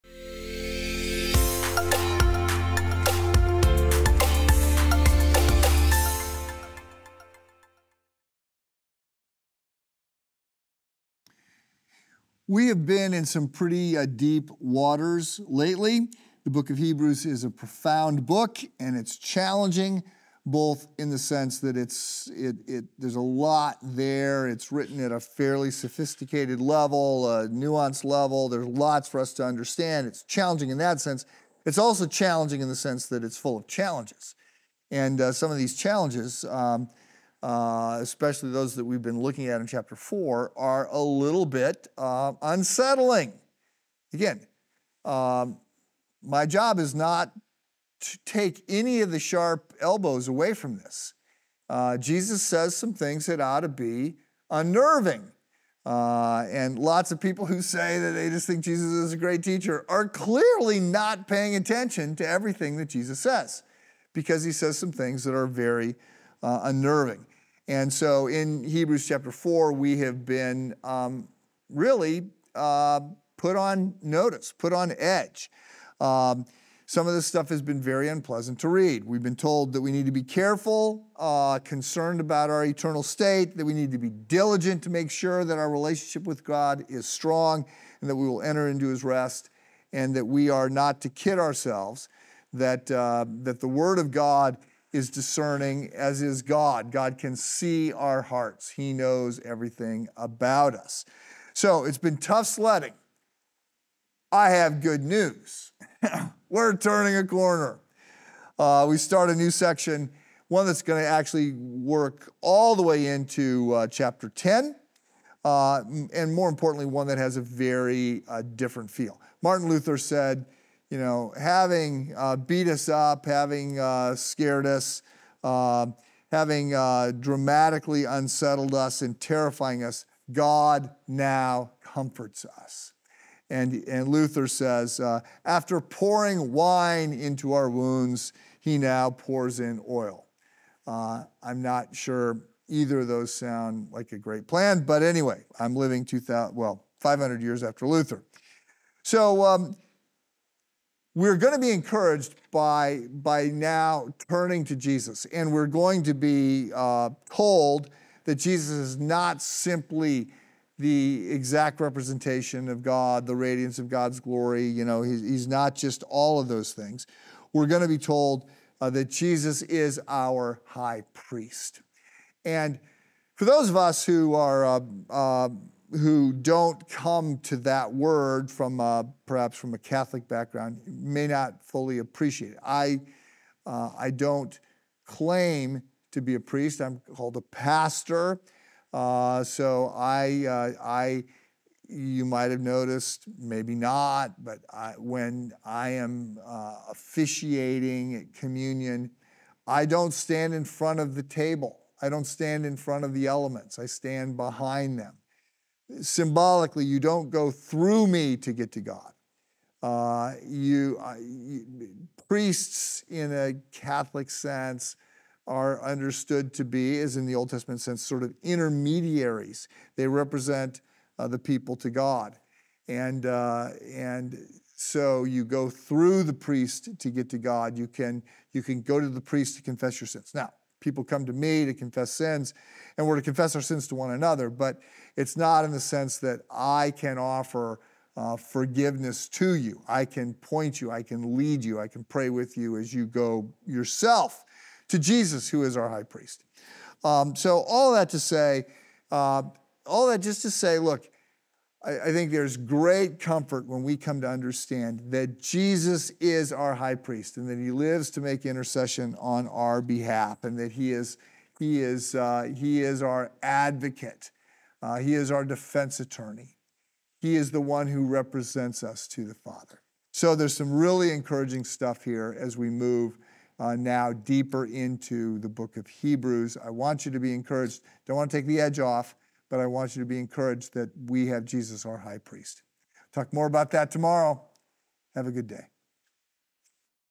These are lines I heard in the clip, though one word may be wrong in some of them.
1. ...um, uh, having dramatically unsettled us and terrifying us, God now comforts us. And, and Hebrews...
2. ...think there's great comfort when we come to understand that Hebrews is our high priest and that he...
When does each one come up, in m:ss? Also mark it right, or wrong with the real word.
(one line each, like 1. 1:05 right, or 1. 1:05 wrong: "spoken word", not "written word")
1. 2:05 wrong: "Luther", not "Hebrews"
2. 4:12 wrong: "Jesus", not "Hebrews".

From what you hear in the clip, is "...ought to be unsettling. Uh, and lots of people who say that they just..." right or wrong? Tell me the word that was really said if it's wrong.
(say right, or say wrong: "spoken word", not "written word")
wrong: "unnerving", not "unsettling".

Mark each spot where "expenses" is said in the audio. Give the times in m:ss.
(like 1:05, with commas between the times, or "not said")
not said.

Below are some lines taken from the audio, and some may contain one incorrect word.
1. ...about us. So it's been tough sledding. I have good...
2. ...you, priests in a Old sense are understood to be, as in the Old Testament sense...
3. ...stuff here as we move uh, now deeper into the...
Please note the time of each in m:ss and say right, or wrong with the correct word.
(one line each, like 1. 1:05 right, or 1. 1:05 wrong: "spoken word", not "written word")
1. 1:40 right
2. 3:31 wrong: "Catholic", not "Old"
3. 4:31 right.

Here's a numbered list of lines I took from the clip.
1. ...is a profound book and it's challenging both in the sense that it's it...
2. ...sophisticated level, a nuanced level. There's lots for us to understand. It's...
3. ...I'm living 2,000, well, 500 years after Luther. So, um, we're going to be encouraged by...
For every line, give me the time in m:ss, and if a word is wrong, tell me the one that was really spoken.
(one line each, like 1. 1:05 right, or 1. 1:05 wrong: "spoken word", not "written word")
1. 0:17 right
2. 0:25 right
3. 2:25 right.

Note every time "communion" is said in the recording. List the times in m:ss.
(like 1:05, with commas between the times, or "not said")
3:18.